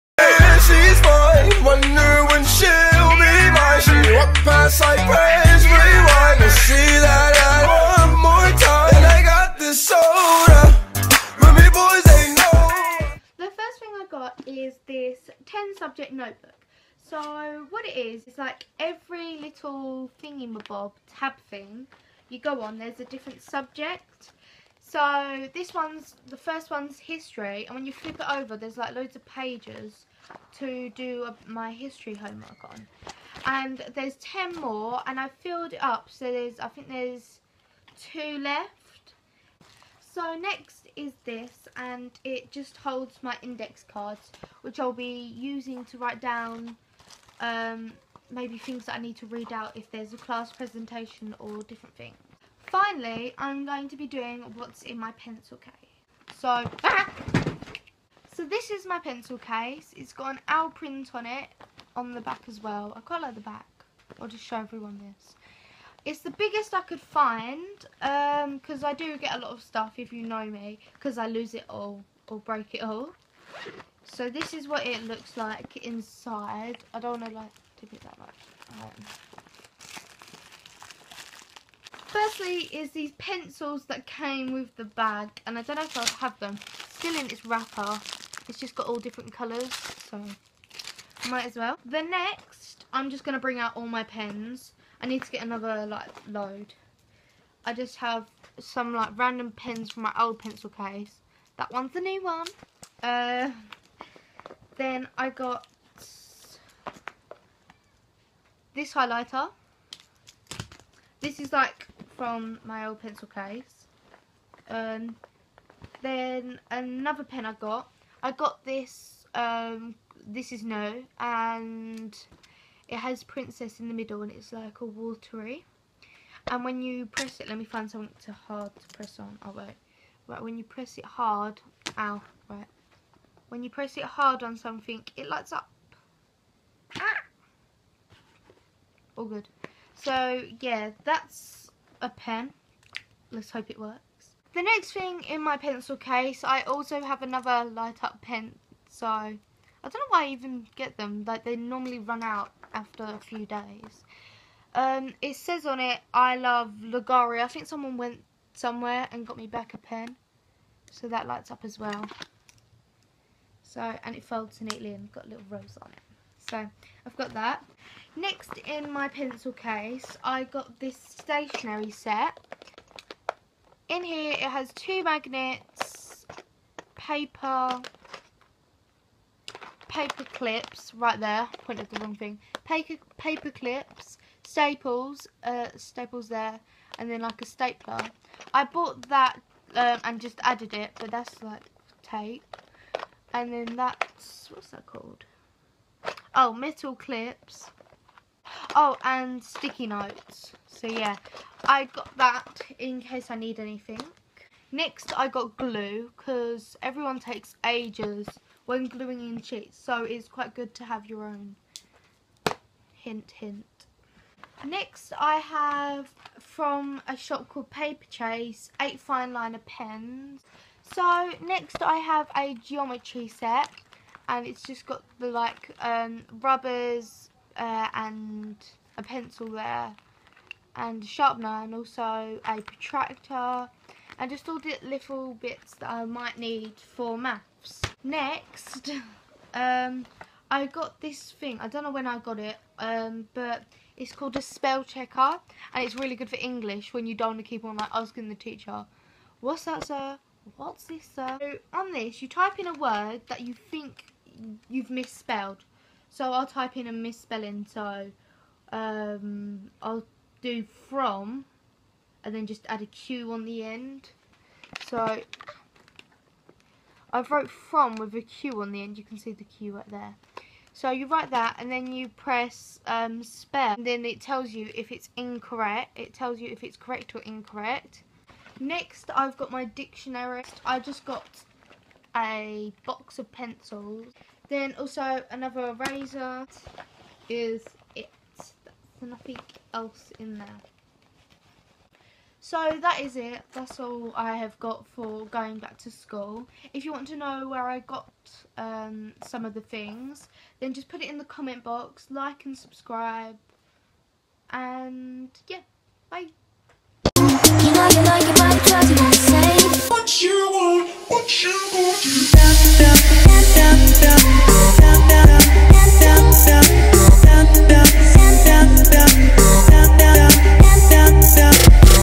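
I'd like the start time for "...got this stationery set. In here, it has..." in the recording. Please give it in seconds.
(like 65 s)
170 s.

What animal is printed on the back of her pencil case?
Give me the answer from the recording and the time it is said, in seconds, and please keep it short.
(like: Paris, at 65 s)
Owl, at 60 s.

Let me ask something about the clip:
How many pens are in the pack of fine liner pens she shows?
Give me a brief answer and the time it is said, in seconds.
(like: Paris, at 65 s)
8, at 218 s.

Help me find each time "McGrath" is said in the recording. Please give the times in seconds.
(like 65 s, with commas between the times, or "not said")
not said.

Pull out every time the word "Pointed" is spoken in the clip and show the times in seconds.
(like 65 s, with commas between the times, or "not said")
181 s.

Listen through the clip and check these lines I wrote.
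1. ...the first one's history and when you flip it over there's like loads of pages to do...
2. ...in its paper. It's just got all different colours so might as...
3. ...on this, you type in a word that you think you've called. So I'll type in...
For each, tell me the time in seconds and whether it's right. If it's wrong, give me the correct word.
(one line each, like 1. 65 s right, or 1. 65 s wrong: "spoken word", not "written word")
1. 26 s right
2. 87 s wrong: "wrapper", not "paper"
3. 251 s wrong: "misspelled", not "called".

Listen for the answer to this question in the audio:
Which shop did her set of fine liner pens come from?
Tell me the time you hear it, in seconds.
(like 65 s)
217 s.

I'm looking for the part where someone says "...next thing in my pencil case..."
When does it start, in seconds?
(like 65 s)
144 s.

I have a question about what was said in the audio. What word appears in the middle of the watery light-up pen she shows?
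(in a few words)
Princess.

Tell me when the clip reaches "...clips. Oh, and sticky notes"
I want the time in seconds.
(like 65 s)
196 s.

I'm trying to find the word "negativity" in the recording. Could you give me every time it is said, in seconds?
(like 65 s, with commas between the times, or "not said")
not said.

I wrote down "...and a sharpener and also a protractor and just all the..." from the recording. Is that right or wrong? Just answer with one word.
right.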